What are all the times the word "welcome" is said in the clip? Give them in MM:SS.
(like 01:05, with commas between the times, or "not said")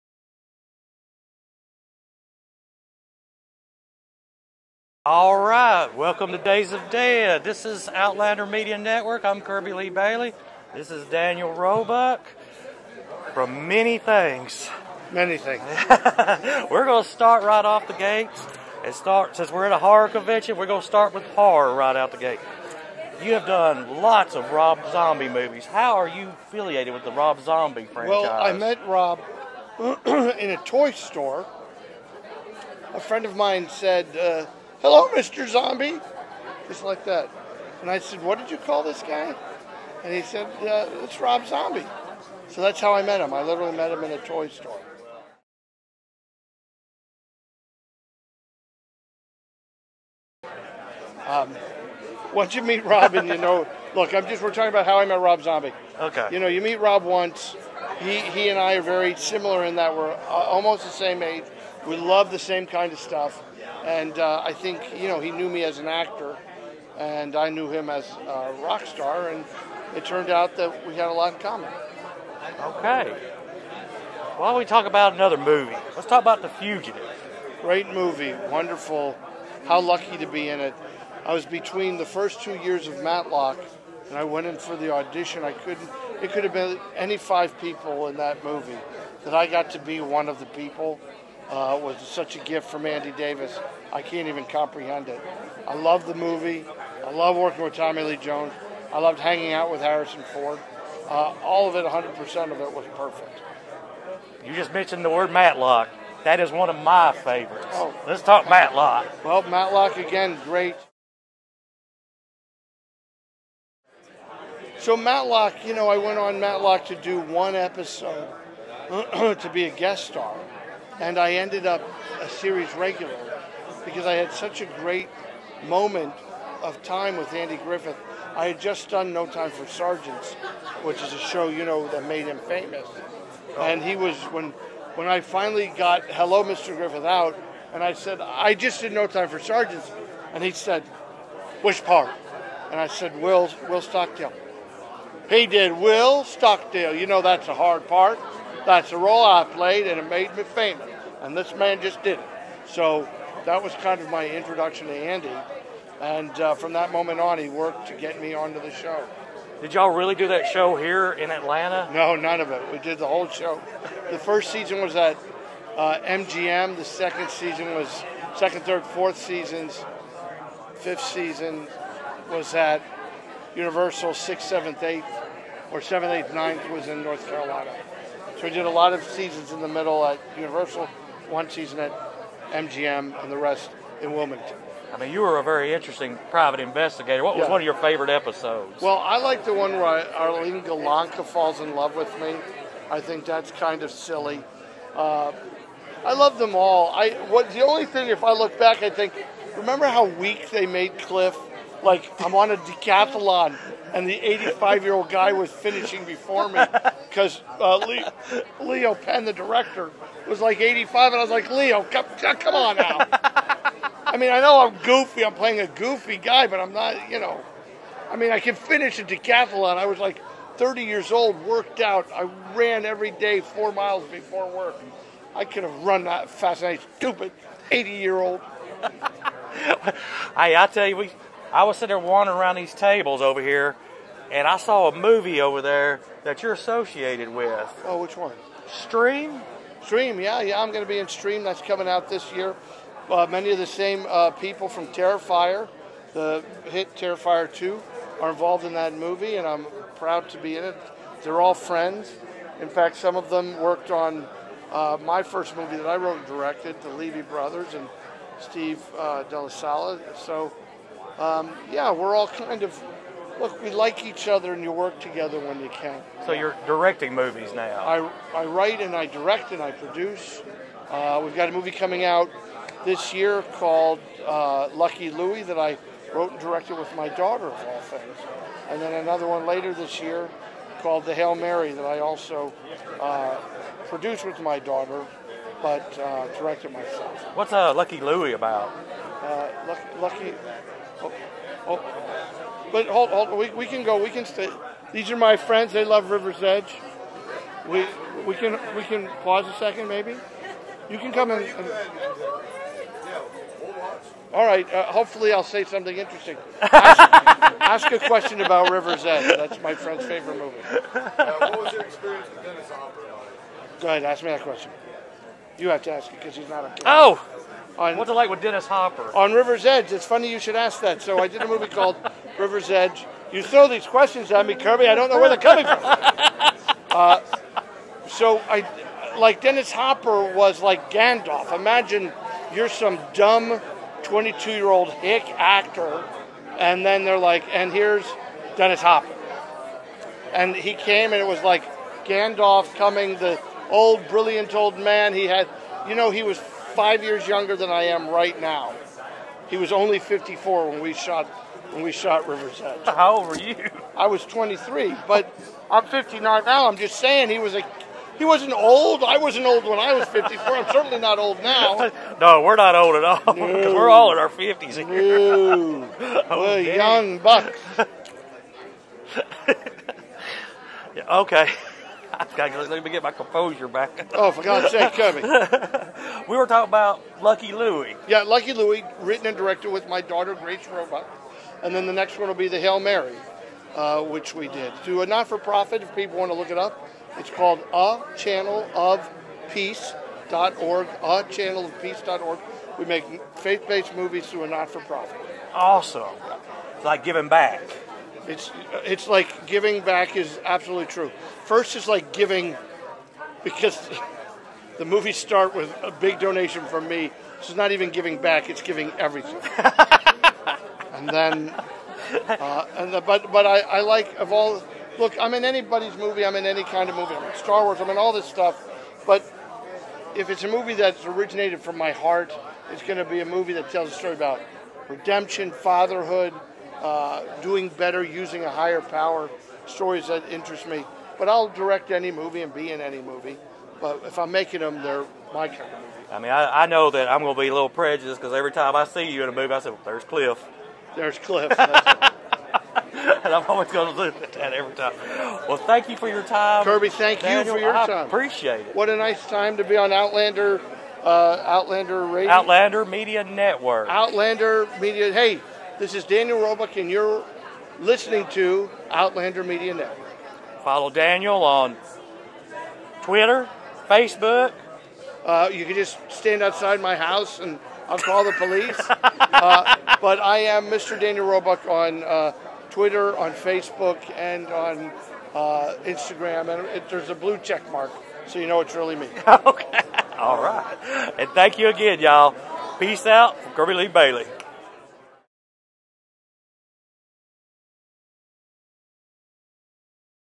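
00:05.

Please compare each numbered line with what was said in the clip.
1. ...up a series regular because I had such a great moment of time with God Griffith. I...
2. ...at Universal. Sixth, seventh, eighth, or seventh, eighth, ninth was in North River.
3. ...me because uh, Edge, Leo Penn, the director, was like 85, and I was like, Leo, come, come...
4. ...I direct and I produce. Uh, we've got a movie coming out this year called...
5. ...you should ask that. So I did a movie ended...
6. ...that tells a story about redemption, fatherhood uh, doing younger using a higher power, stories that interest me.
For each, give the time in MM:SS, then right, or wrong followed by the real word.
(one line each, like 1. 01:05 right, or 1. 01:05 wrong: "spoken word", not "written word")
1. 02:01 wrong: "Andy", not "God"
2. 02:52 wrong: "Carolina", not "River"
3. 03:26 wrong: "Leo", not "Edge"
4. 04:28 right
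5. 05:20 wrong: "called", not "ended"
6. 07:03 wrong: "better", not "younger".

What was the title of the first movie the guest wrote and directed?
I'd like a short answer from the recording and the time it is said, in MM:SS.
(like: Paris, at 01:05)
The Levy Brothers, at 04:16.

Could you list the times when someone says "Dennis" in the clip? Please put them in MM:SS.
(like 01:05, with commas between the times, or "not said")
05:12, 05:18, 05:29, 05:38.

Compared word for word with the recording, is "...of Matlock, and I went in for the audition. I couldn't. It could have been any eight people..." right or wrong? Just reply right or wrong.
wrong.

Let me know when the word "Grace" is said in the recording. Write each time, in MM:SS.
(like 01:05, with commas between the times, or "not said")
06:20.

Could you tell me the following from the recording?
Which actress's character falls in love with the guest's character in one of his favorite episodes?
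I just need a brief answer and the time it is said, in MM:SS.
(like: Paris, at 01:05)
Arlene Golonka, at 03:10.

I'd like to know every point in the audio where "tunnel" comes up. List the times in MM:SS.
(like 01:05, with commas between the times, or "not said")
not said.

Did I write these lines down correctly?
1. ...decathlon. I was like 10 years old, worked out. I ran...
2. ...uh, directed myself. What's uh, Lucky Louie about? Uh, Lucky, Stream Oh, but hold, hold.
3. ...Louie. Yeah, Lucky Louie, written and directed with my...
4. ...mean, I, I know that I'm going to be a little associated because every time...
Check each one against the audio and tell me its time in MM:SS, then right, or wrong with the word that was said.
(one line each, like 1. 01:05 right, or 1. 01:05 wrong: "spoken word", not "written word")
1. 03:39 wrong: "30", not "10"
2. 04:45 wrong: "Lucky", not "Stream"
3. 06:17 right
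4. 07:16 wrong: "prejudiced", not "associated".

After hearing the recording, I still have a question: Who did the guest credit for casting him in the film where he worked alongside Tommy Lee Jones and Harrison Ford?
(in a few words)
Andy Davis.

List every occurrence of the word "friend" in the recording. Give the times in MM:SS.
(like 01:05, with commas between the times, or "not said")
00:32, 04:11, 04:55, 05:09.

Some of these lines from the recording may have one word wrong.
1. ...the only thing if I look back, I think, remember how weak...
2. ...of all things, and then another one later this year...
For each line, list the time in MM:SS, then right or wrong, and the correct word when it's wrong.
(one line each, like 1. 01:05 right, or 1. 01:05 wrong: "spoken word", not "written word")
1. 03:17 right
2. 04:37 right.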